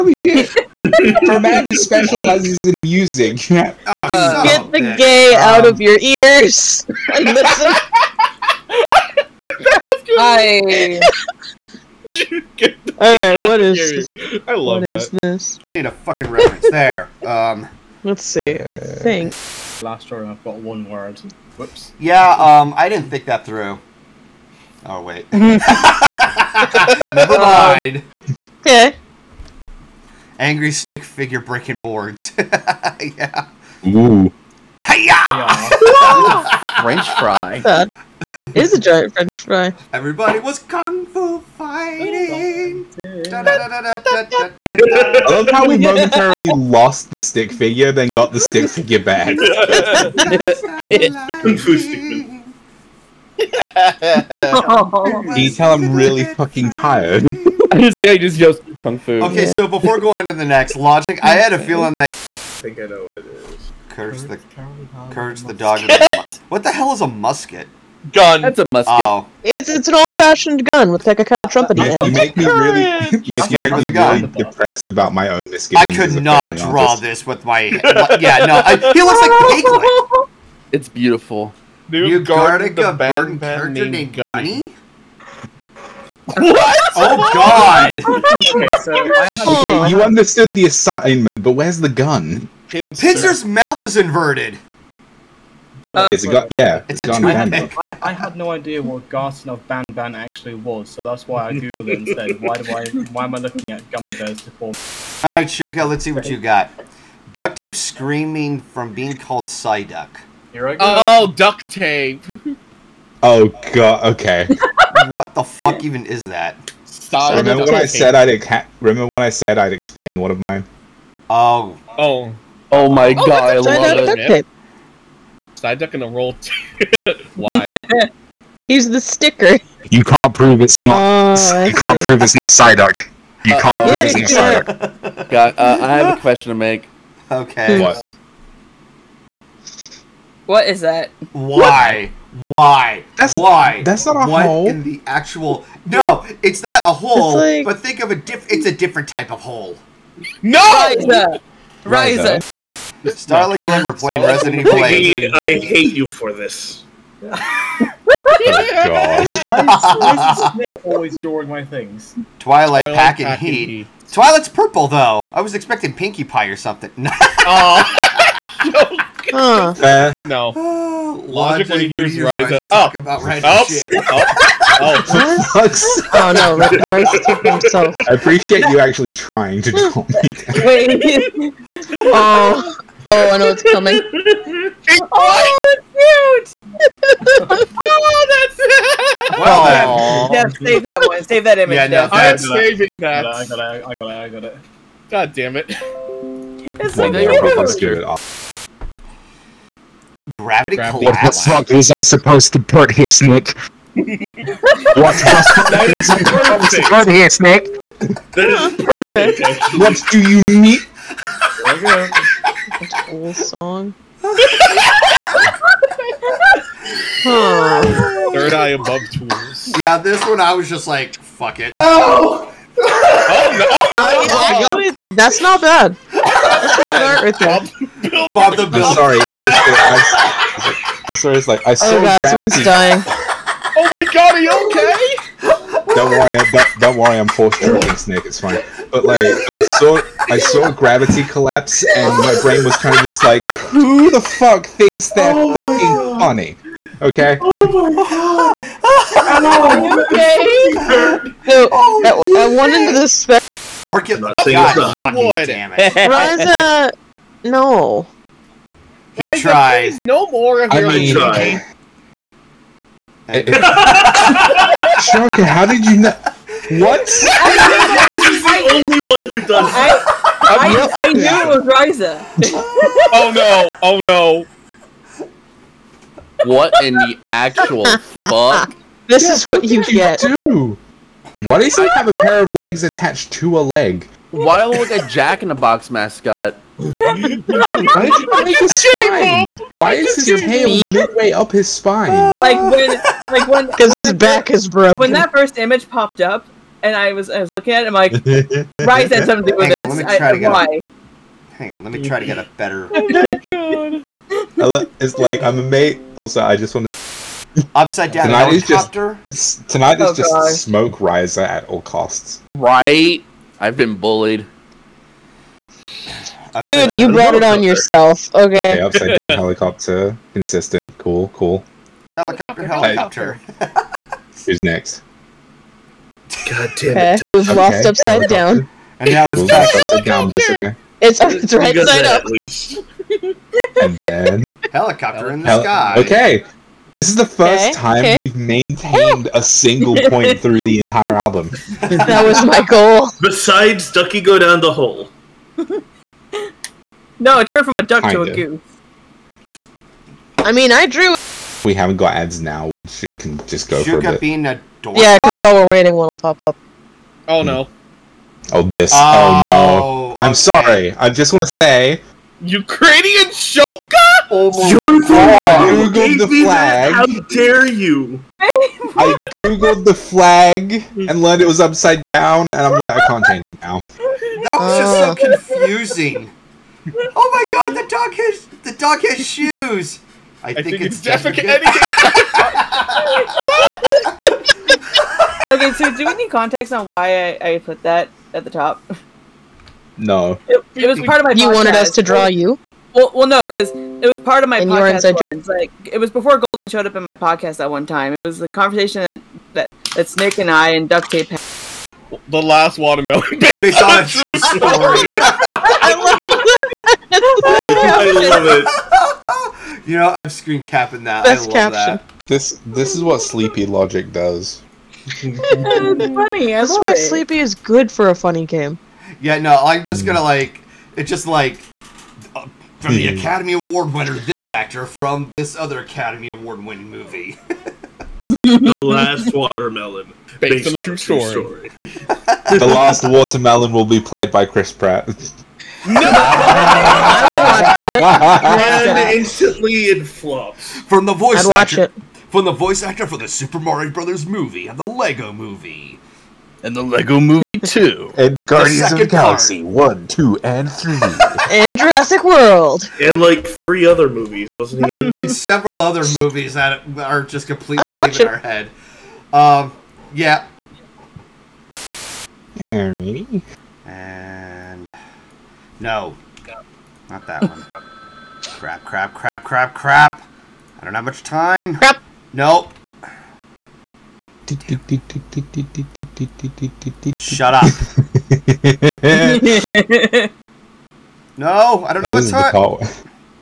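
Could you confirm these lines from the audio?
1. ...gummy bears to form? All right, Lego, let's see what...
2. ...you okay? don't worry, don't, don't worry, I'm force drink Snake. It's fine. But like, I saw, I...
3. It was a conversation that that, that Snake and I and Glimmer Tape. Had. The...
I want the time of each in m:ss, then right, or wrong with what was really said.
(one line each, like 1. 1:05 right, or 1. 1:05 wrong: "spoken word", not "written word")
1. 1:43 wrong: "Shurika", not "Lego"
2. 3:54 right
3. 6:38 wrong: "Duct", not "Glimmer".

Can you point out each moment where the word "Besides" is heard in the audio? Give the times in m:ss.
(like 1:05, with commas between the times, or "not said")
5:43.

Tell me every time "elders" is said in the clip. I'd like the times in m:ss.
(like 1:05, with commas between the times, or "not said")
not said.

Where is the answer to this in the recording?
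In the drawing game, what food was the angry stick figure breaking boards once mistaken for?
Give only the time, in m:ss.
0:38.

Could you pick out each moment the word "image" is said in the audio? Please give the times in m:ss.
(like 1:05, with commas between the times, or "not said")
3:11, 4:55.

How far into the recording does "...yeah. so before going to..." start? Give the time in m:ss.
0:59.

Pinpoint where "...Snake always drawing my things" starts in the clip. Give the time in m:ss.
2:40.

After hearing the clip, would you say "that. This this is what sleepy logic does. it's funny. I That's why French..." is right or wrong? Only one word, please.
wrong.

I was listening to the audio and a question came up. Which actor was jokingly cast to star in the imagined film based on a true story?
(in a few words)
Chris Pratt.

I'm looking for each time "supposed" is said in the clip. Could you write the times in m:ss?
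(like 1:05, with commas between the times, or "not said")
3:21, 3:26.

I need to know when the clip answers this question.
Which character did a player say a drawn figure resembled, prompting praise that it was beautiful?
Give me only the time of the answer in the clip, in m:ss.
1:19.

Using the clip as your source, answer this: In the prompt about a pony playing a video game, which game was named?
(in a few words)
Resident Evil.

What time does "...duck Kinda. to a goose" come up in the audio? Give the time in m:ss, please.
5:47.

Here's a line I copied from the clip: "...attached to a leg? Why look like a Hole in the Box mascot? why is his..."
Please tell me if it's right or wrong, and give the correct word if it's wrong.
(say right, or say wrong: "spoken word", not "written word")
wrong: "Jack", not "Hole".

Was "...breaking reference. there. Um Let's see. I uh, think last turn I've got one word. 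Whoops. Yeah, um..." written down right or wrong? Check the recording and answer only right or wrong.
wrong.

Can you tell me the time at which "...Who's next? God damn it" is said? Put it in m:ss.
5:24.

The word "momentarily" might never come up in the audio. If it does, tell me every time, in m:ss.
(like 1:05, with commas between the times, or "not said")
0:45.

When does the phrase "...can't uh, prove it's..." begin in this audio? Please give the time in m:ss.
2:13.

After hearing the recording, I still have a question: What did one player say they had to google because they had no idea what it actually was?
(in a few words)
Garten of Banban.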